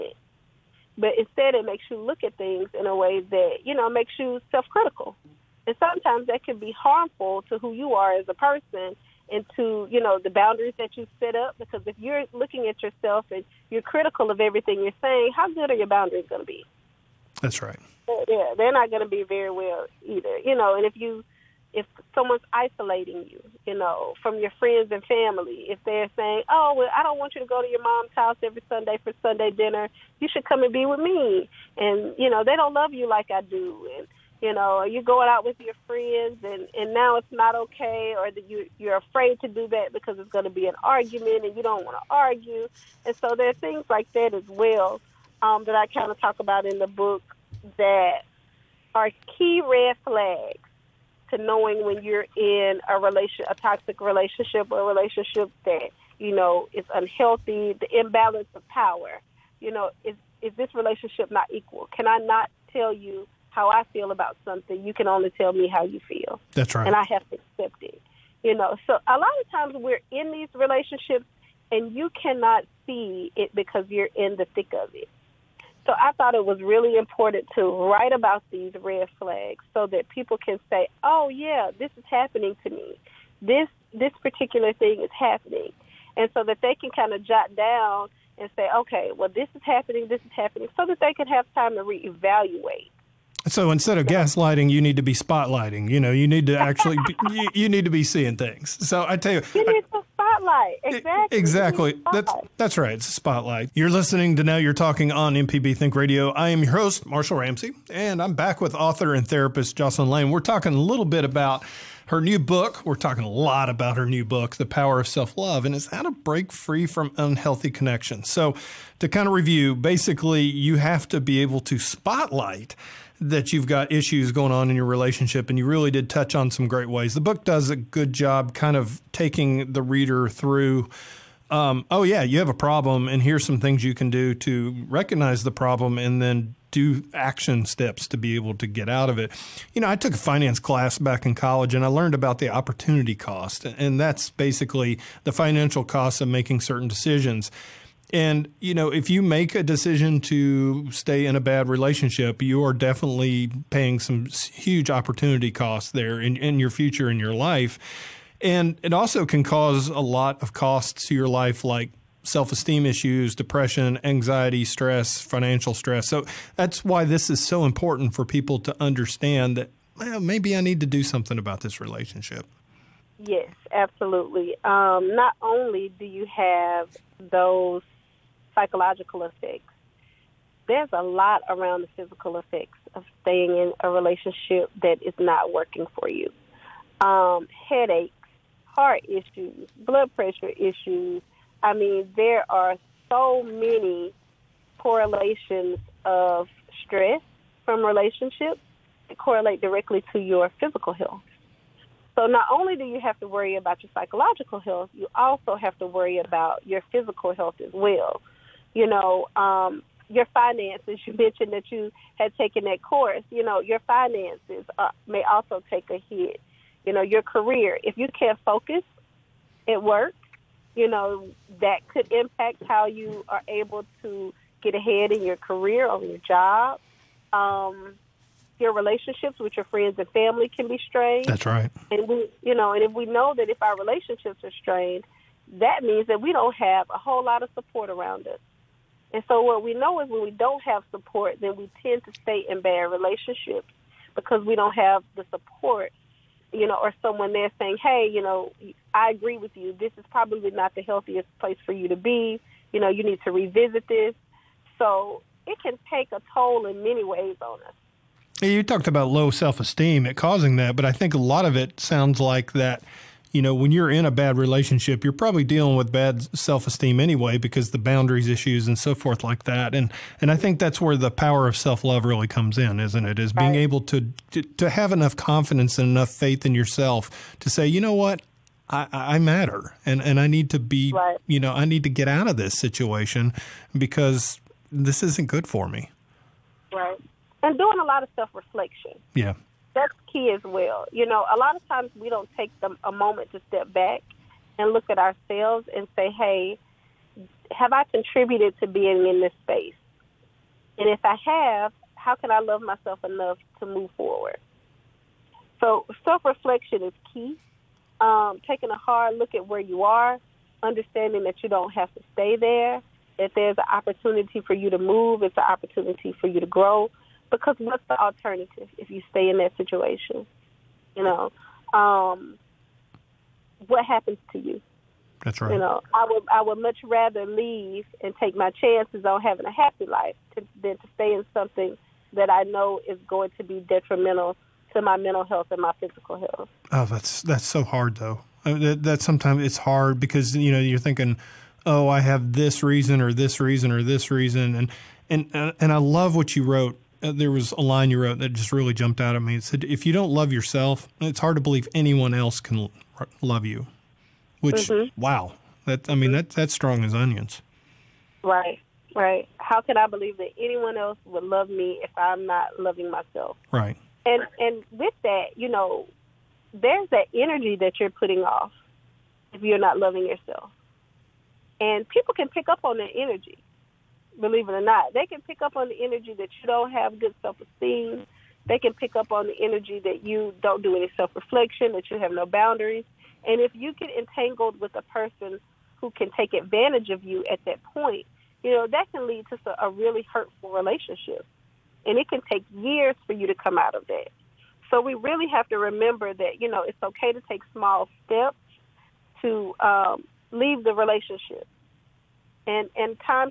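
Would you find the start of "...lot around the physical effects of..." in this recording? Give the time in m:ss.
3:01.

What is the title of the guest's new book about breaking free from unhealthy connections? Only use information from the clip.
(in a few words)
The Power of Self Love.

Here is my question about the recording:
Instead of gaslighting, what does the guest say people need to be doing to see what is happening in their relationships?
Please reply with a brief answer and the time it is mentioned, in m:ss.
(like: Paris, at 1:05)
spotlighting, at 1:35.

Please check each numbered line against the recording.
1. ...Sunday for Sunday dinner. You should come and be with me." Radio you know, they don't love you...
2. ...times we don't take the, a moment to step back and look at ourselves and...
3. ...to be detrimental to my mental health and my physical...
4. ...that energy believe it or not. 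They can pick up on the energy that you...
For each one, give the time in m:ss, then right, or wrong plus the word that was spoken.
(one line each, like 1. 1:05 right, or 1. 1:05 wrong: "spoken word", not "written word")
1. 0:28 wrong: "And", not "Radio"
2. 4:51 right
3. 5:33 right
4. 6:12 right.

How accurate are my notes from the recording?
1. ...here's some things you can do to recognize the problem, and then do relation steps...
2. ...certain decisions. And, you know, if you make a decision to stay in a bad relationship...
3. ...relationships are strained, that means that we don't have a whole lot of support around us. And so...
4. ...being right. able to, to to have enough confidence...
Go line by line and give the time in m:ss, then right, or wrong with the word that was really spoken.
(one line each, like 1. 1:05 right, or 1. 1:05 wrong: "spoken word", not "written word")
1. 2:13 wrong: "action", not "relation"
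2. 2:26 right
3. 3:53 right
4. 4:33 right.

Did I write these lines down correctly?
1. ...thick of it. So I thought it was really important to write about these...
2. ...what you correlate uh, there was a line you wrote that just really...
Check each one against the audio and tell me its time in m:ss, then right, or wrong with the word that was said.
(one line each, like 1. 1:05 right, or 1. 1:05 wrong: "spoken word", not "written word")
1. 1:14 right
2. 5:46 wrong: "wrote", not "correlate".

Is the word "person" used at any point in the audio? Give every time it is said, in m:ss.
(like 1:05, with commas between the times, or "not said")
0:08, 6:24.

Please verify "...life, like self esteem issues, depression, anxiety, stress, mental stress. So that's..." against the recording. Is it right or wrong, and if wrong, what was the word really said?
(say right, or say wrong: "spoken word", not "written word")
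wrong: "financial", not "mental".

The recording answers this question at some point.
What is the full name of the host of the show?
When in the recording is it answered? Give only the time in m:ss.
1:47.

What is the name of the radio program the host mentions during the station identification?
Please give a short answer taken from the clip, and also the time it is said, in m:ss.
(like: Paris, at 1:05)
MPB Think Radio, at 1:45.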